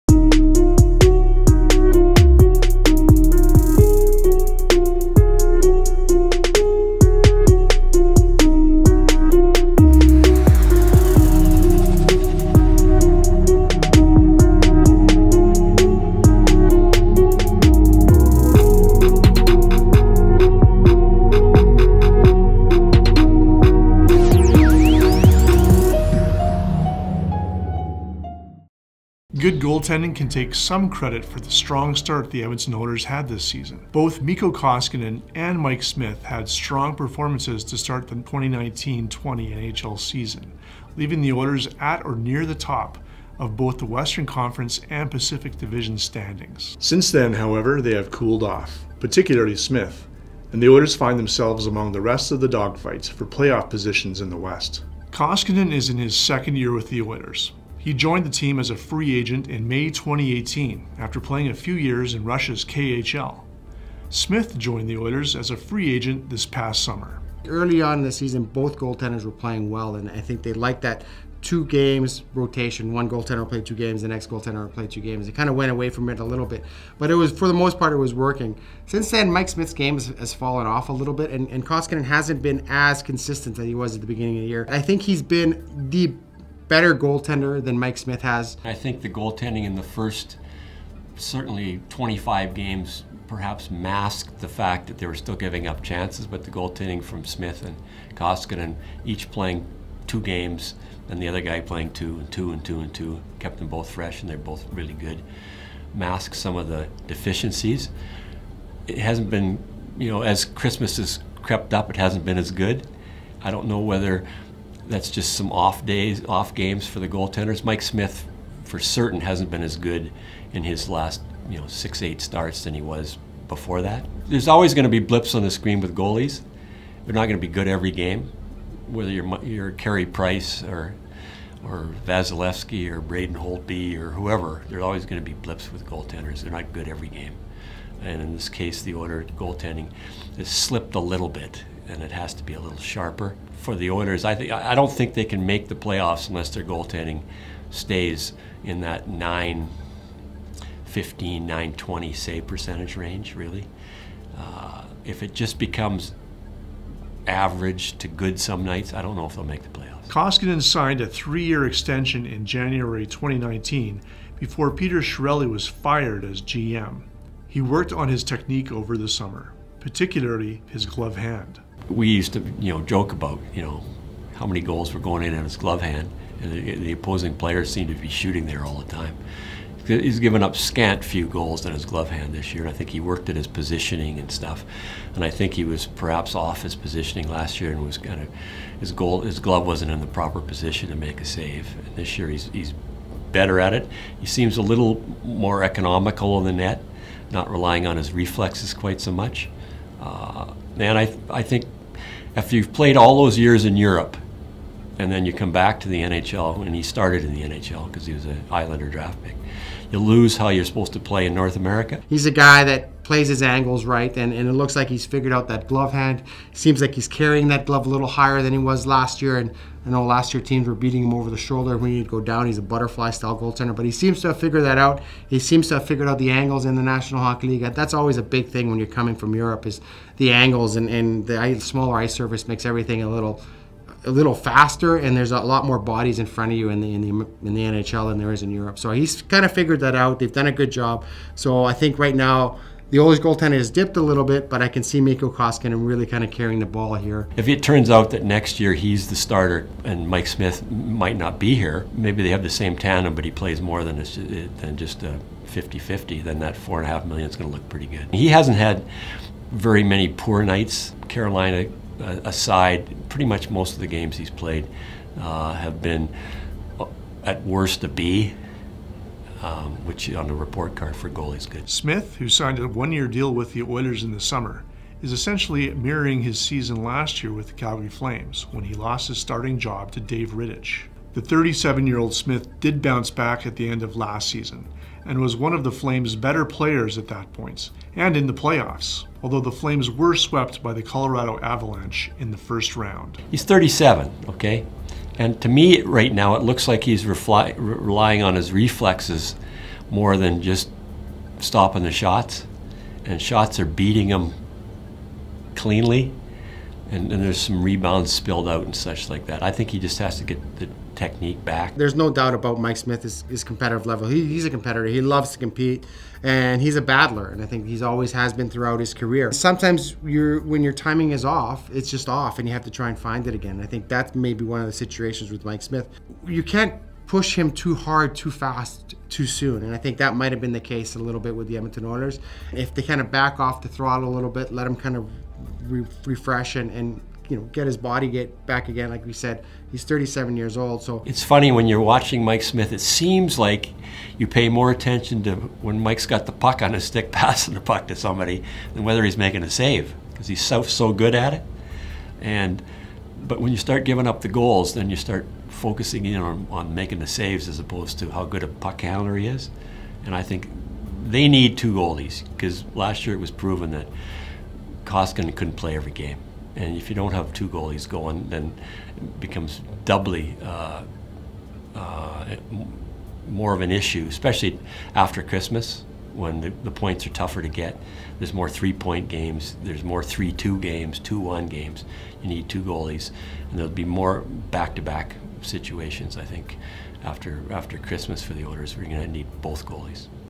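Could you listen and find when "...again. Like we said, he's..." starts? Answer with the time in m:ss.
5:38.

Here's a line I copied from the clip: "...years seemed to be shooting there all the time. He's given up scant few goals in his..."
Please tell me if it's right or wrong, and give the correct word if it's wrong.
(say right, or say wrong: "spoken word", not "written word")
wrong: "players", not "years".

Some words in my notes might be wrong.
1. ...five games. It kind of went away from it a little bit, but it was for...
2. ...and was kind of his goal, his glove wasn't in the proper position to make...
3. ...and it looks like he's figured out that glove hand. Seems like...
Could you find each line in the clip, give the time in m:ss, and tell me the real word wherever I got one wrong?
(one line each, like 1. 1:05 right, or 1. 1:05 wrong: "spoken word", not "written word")
1. 1:14 wrong: "two", not "five"
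2. 3:07 right
3. 3:34 right.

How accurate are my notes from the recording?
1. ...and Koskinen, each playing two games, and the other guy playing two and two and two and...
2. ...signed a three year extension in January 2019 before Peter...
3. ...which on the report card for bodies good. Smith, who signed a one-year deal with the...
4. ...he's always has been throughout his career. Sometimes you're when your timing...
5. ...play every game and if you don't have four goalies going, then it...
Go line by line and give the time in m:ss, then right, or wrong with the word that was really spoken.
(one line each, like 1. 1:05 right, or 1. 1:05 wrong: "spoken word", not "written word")
1. 1:37 right
2. 2:40 right
3. 4:29 wrong: "goalies", not "bodies"
4. 5:17 right
5. 6:05 wrong: "two", not "four".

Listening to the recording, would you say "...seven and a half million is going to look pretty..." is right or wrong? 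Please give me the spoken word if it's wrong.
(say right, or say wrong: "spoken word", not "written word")
wrong: "four", not "seven".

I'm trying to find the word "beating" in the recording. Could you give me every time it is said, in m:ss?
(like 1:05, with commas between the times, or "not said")
3:40, 5:03.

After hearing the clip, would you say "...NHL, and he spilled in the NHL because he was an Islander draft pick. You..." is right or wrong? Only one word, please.
wrong.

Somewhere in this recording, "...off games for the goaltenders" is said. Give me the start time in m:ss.
1:56.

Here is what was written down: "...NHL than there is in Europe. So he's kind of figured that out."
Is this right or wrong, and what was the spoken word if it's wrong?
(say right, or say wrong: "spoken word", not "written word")
right.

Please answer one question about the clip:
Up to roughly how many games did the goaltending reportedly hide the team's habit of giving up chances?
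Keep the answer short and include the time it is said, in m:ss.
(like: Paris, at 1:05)
25, at 1:31.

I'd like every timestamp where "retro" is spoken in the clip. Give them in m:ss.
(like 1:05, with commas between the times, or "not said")
not said.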